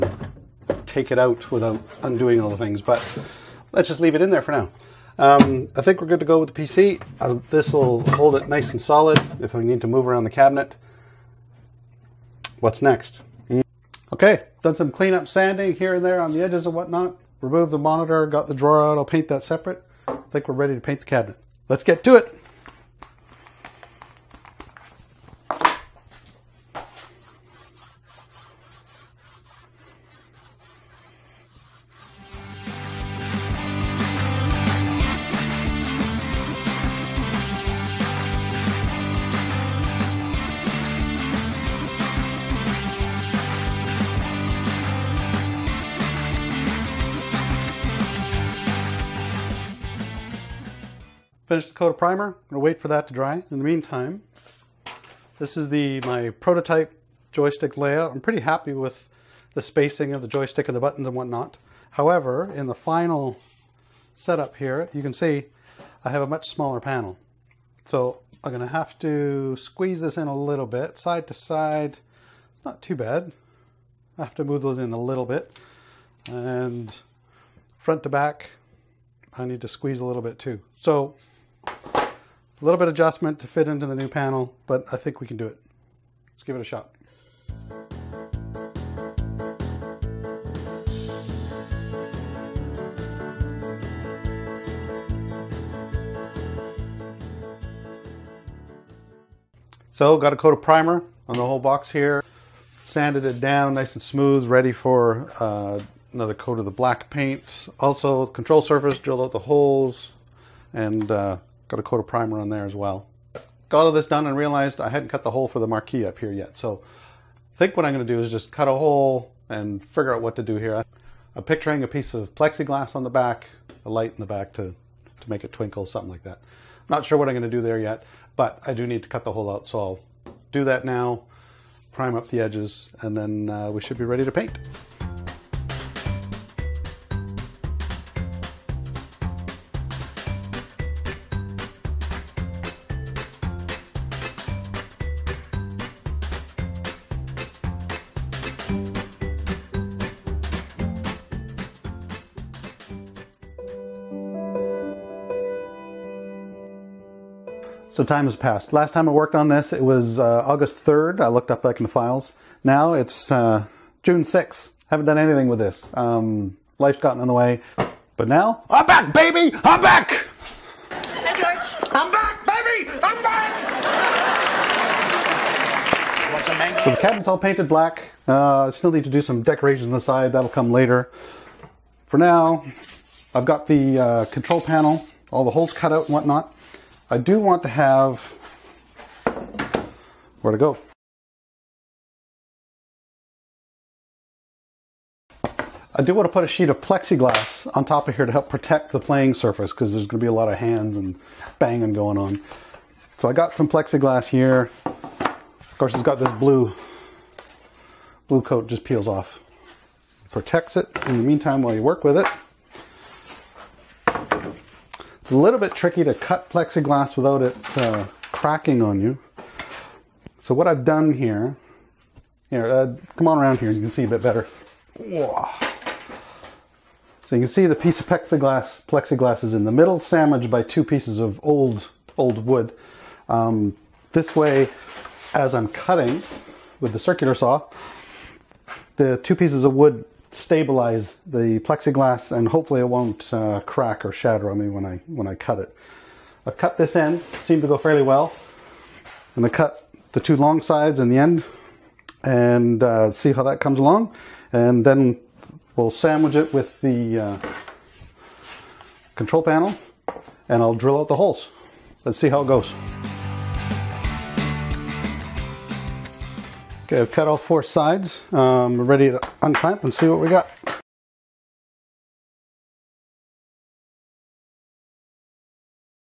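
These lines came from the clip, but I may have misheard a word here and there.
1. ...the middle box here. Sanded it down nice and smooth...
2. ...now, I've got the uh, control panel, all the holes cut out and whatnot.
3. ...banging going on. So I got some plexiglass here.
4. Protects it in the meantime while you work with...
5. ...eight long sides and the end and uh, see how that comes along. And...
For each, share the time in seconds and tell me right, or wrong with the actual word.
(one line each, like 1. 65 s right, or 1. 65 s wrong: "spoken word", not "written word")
1. 101 s wrong: "whole", not "middle"
2. 182 s right
3. 201 s right
4. 210 s right
5. 250 s wrong: "two", not "eight".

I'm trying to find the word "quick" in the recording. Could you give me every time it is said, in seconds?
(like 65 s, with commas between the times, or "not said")
not said.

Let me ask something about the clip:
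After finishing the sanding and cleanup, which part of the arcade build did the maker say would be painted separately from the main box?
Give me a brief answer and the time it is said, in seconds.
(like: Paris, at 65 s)
The drawer, at 18 s.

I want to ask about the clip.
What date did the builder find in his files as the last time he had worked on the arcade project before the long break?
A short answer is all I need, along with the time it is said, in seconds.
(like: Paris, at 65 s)
August 3rd, at 160 s.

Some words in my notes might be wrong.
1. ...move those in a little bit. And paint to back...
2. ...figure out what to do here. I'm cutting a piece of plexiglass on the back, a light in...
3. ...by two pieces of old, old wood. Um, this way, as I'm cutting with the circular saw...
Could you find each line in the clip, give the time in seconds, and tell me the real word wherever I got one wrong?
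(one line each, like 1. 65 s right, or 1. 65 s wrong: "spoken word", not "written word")
1. 74 s wrong: "front", not "paint"
2. 119 s wrong: "picturing", not "cutting"
3. 230 s right.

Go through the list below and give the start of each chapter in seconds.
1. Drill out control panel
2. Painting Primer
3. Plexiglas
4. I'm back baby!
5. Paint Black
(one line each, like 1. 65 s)
1. 52 s
2. 13 s
3. 177 s
4. 156 s
5. 126 s.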